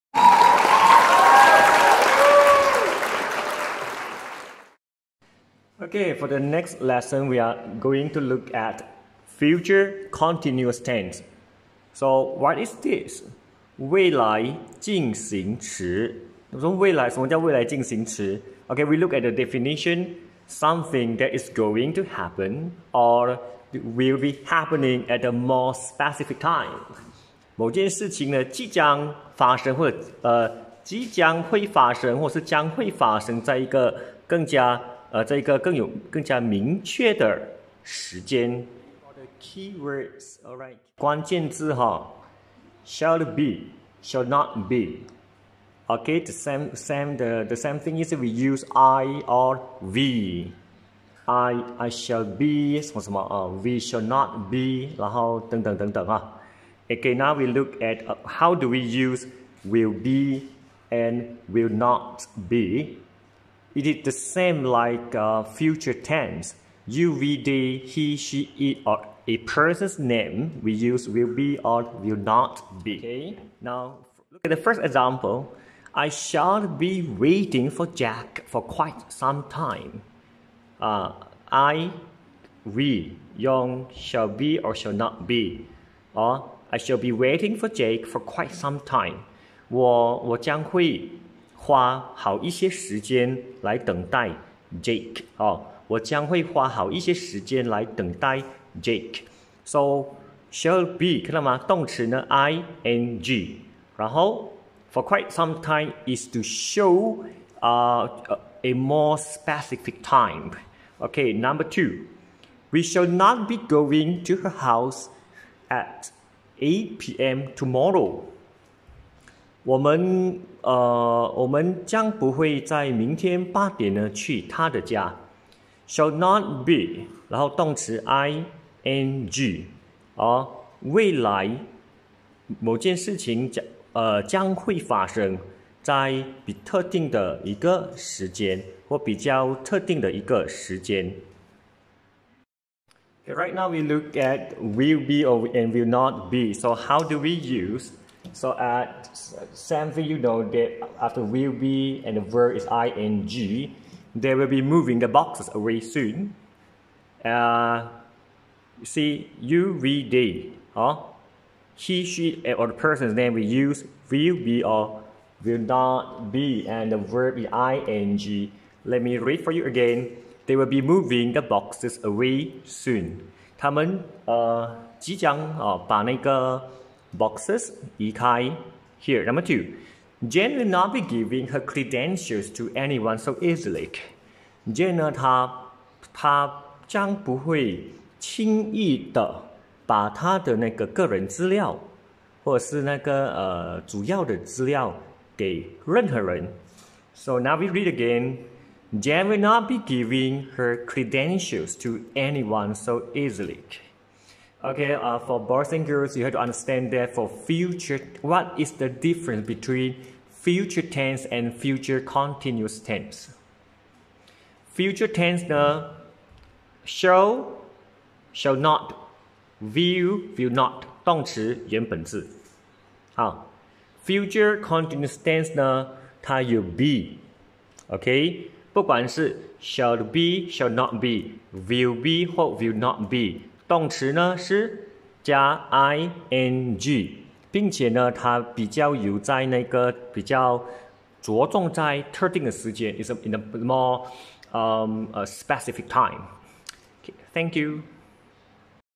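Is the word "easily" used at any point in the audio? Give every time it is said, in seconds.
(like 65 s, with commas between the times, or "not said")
183 s, 203 s.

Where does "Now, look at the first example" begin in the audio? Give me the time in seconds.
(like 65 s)
73 s.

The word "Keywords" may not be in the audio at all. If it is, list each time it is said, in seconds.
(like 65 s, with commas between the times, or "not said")
39 s.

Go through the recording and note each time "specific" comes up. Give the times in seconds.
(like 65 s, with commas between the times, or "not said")
25 s, 109 s, 245 s.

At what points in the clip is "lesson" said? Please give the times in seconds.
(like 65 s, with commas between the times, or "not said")
6 s.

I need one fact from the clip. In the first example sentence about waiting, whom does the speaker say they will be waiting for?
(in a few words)
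Jack.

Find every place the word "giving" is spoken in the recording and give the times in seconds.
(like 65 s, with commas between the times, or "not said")
181 s, 199 s.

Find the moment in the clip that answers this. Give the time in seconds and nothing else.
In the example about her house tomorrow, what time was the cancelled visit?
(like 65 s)
116 s.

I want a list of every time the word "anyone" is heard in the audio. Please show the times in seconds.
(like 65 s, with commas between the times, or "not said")
182 s, 202 s.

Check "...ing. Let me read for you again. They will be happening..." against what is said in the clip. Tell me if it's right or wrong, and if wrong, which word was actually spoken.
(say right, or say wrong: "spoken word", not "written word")
wrong: "moving", not "happening".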